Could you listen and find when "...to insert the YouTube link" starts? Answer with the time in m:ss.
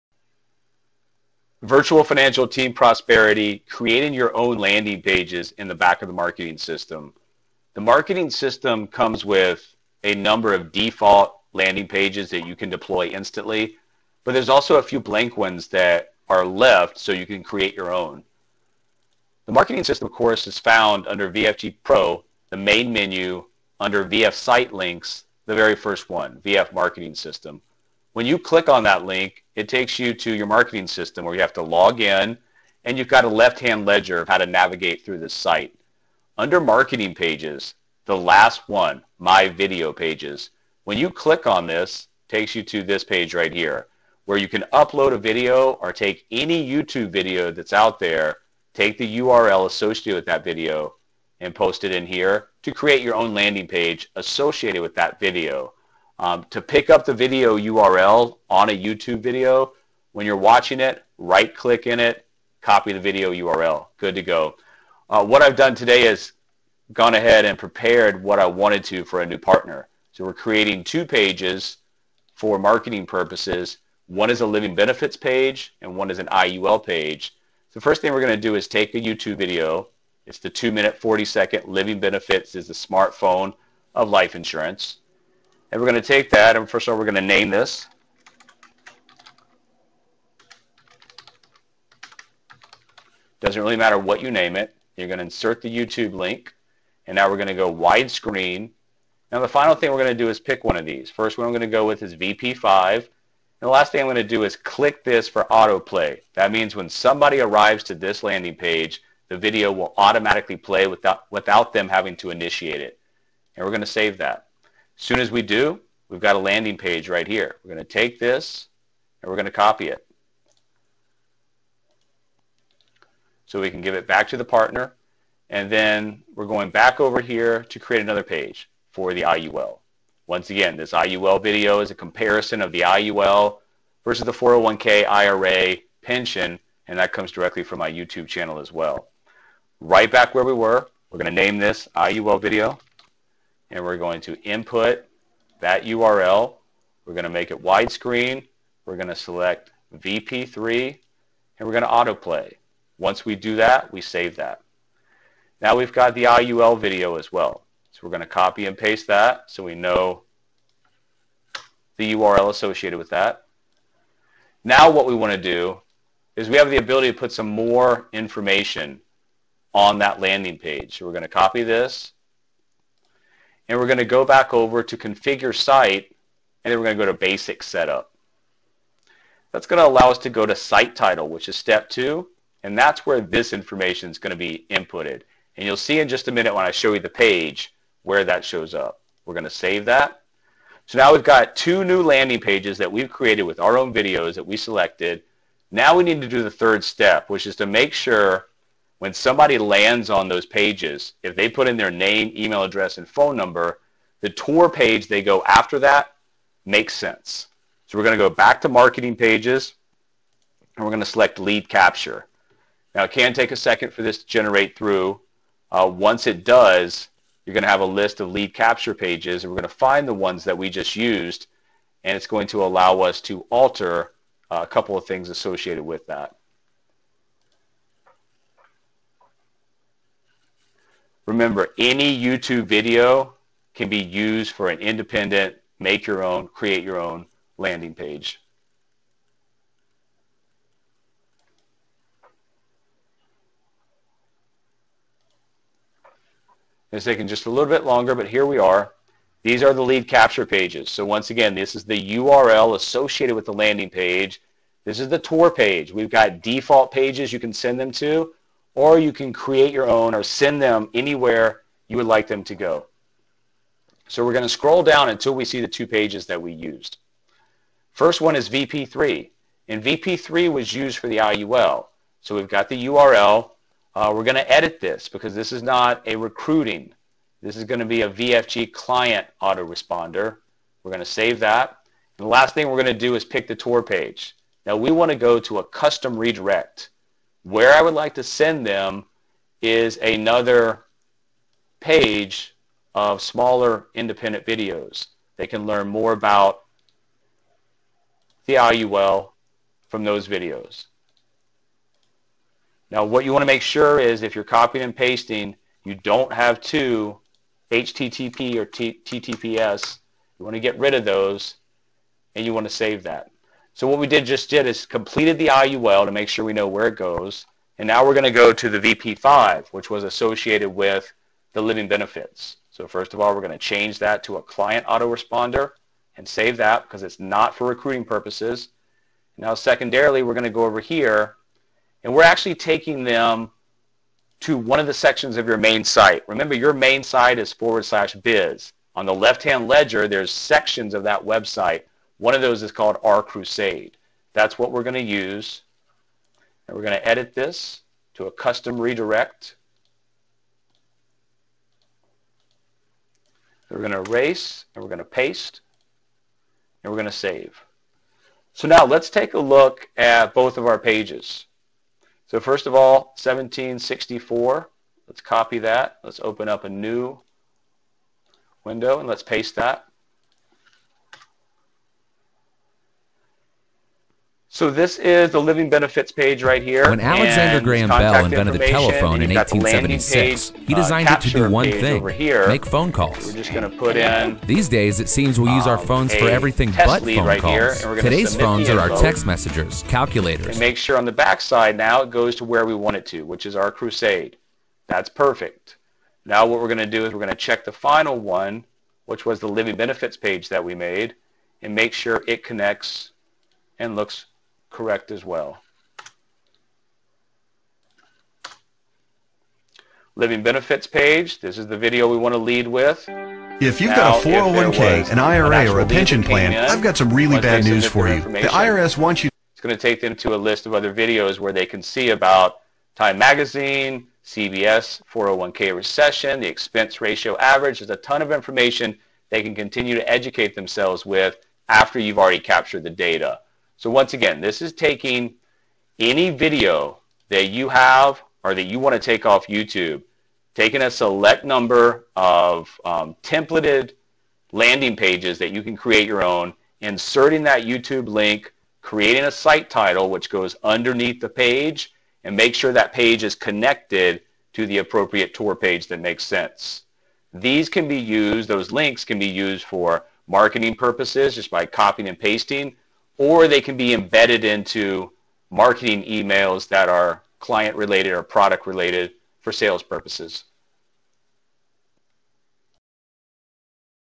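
1:35.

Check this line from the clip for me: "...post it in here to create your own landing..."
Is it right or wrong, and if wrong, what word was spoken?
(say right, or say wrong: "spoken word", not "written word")
right.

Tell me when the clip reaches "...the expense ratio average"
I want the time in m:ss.
7:06.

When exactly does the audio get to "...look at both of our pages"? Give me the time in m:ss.
5:59.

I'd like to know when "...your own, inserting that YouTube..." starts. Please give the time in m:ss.
7:26.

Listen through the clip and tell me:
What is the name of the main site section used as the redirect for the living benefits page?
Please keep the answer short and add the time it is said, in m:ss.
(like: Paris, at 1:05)
R Crusade, at 5:43.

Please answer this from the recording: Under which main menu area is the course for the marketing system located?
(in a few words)
VFG Pro.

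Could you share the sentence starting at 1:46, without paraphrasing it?
That means when somebody arrives to this landing page, the video will automatically play without, without them having to initiate it.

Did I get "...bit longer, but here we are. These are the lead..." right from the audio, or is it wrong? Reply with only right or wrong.
right.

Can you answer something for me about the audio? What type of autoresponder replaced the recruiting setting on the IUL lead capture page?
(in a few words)
VFG client autoresponder.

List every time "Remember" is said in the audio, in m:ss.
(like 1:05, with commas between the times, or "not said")
3:51, 5:36.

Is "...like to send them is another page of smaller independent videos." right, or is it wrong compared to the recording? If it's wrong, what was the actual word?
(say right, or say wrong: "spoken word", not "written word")
right.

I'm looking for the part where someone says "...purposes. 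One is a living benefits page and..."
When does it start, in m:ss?
1:13.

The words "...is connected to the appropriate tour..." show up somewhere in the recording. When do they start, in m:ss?
7:33.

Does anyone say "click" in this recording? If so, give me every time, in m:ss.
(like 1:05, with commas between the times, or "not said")
0:28, 0:41, 1:01, 1:44.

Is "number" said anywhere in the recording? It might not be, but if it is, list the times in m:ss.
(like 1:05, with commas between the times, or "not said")
0:10, 3:23, 7:21.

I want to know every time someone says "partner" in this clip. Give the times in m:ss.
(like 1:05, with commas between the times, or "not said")
1:09, 2:04.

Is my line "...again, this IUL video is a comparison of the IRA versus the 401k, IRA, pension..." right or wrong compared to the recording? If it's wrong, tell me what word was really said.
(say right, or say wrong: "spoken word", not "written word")
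wrong: "IUL", not "IRA".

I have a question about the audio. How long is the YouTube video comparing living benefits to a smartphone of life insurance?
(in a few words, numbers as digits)
2 minutes 40 seconds.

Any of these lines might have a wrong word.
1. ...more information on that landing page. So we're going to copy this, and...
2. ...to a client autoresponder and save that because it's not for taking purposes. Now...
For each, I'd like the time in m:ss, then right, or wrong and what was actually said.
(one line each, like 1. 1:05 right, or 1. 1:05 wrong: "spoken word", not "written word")
1. 2:47 right
2. 5:24 wrong: "recruiting", not "taking".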